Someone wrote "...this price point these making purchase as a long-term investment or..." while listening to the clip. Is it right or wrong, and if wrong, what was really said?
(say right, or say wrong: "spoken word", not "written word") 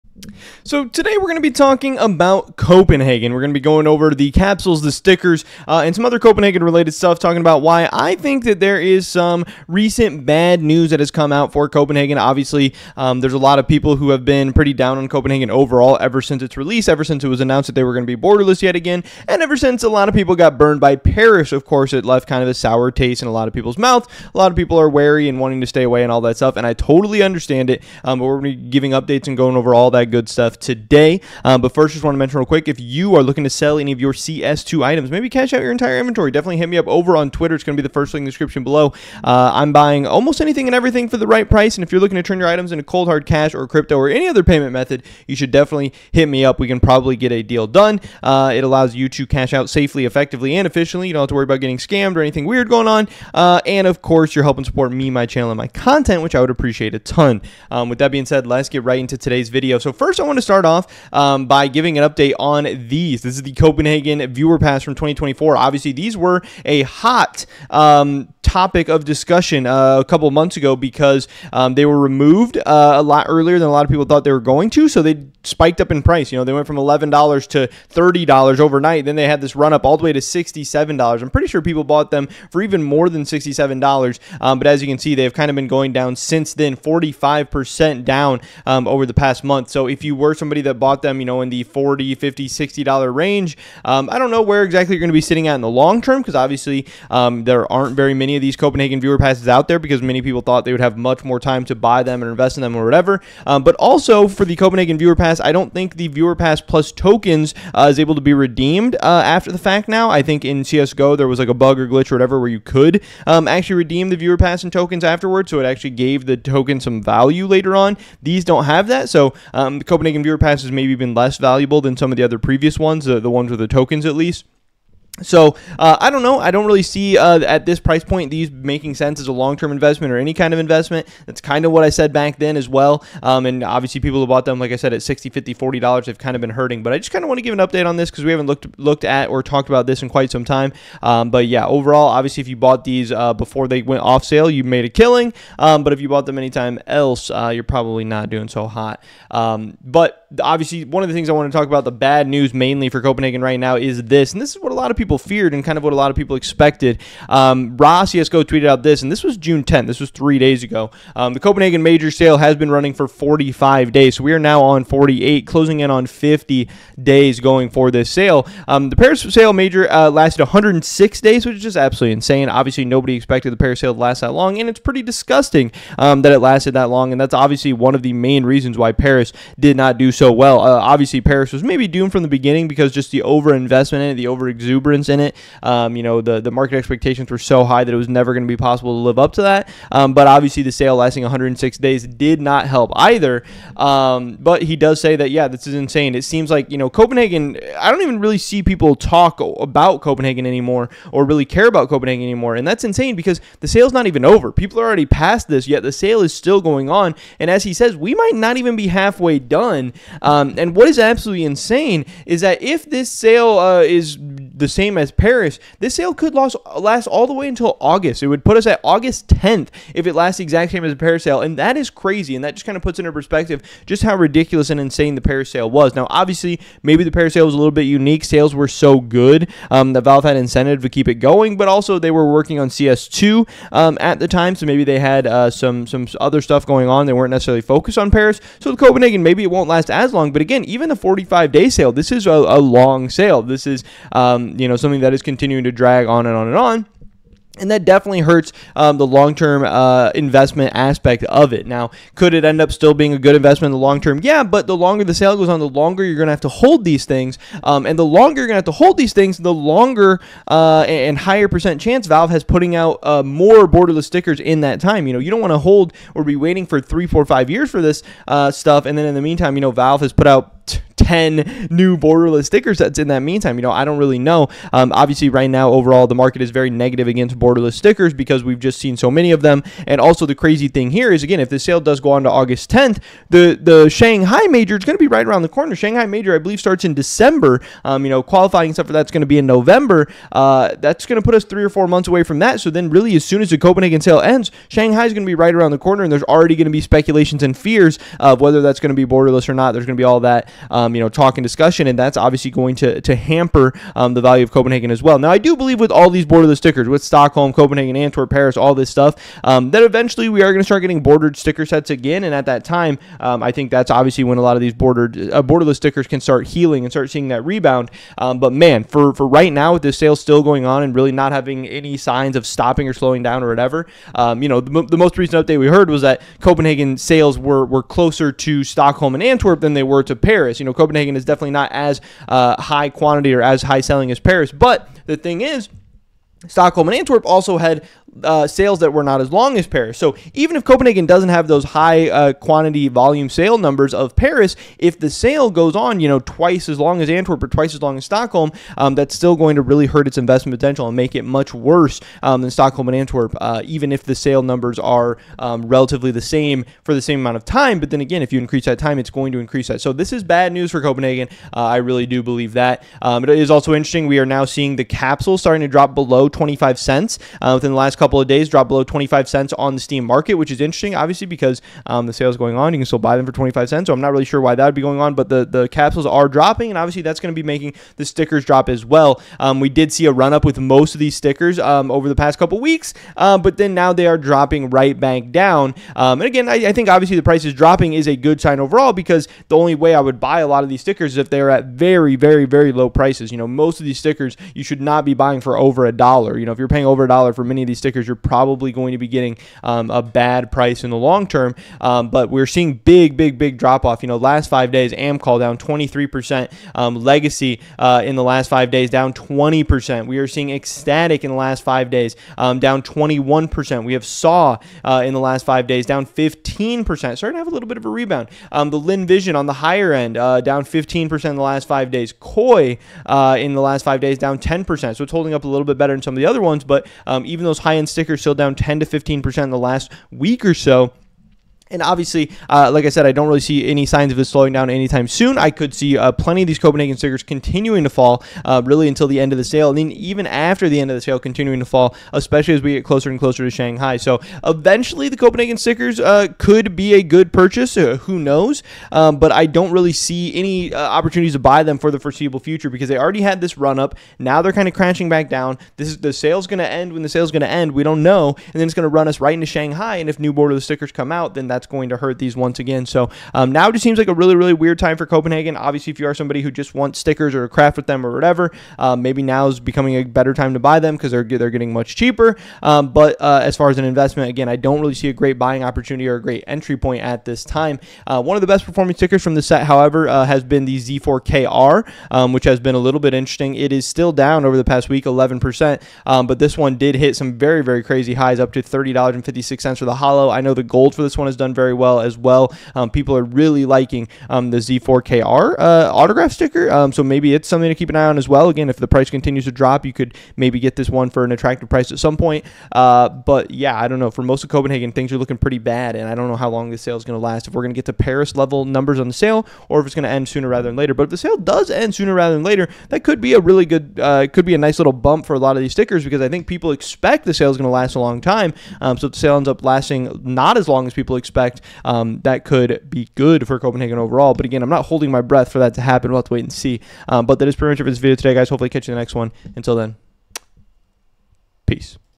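wrong: "sense", not "purchase".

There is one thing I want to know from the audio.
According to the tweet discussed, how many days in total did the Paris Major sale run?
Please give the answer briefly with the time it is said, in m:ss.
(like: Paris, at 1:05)
106 days, at 2:50.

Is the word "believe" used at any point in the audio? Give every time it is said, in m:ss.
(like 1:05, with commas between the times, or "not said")
4:46, 5:05, 6:02.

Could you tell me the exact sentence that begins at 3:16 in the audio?
It seems like, you know, Copenhagen, I don't even really see people talk about Copenhagen anymore or really care about Copenhagen anymore.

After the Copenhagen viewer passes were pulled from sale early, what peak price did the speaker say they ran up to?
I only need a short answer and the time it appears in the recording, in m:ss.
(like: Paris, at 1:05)
$67, at 1:19.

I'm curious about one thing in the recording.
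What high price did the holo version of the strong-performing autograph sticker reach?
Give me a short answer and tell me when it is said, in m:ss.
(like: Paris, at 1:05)
$30.56, at 8:08.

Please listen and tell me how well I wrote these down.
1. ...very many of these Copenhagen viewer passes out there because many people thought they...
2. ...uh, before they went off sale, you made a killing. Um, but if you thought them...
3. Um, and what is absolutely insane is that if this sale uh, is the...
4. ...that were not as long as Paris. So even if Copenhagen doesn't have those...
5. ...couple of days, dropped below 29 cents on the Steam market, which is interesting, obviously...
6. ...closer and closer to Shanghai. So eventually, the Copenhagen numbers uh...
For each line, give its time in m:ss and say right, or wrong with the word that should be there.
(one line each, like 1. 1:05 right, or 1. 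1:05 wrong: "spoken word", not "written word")
1. 1:37 right
2. 2:23 wrong: "bought", not "thought"
3. 3:30 right
4. 5:38 right
5. 6:08 wrong: "25", not "29"
6. 7:22 wrong: "stickers", not "numbers".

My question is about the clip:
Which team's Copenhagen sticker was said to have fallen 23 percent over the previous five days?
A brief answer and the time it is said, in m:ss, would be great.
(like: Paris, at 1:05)
Amkal, at 6:44.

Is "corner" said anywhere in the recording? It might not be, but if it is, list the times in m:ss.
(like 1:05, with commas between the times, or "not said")
4:45, 4:55.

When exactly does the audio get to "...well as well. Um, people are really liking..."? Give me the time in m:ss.
8:11.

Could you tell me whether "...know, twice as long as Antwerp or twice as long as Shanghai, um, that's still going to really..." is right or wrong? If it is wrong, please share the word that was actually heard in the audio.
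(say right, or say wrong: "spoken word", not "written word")
wrong: "Stockholm", not "Shanghai".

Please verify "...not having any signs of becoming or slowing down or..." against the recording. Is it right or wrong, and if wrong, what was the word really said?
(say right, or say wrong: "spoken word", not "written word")
wrong: "stopping", not "becoming".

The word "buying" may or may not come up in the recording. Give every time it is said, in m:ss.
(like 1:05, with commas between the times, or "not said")
0:39, 6:35, 7:55.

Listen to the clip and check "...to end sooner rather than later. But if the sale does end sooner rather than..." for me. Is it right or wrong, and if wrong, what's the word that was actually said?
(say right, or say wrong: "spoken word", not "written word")
right.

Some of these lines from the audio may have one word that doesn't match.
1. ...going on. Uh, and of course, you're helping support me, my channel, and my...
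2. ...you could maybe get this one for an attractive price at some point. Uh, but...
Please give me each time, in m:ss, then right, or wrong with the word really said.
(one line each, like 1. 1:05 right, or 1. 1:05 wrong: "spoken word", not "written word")
1. 0:52 right
2. 8:19 right.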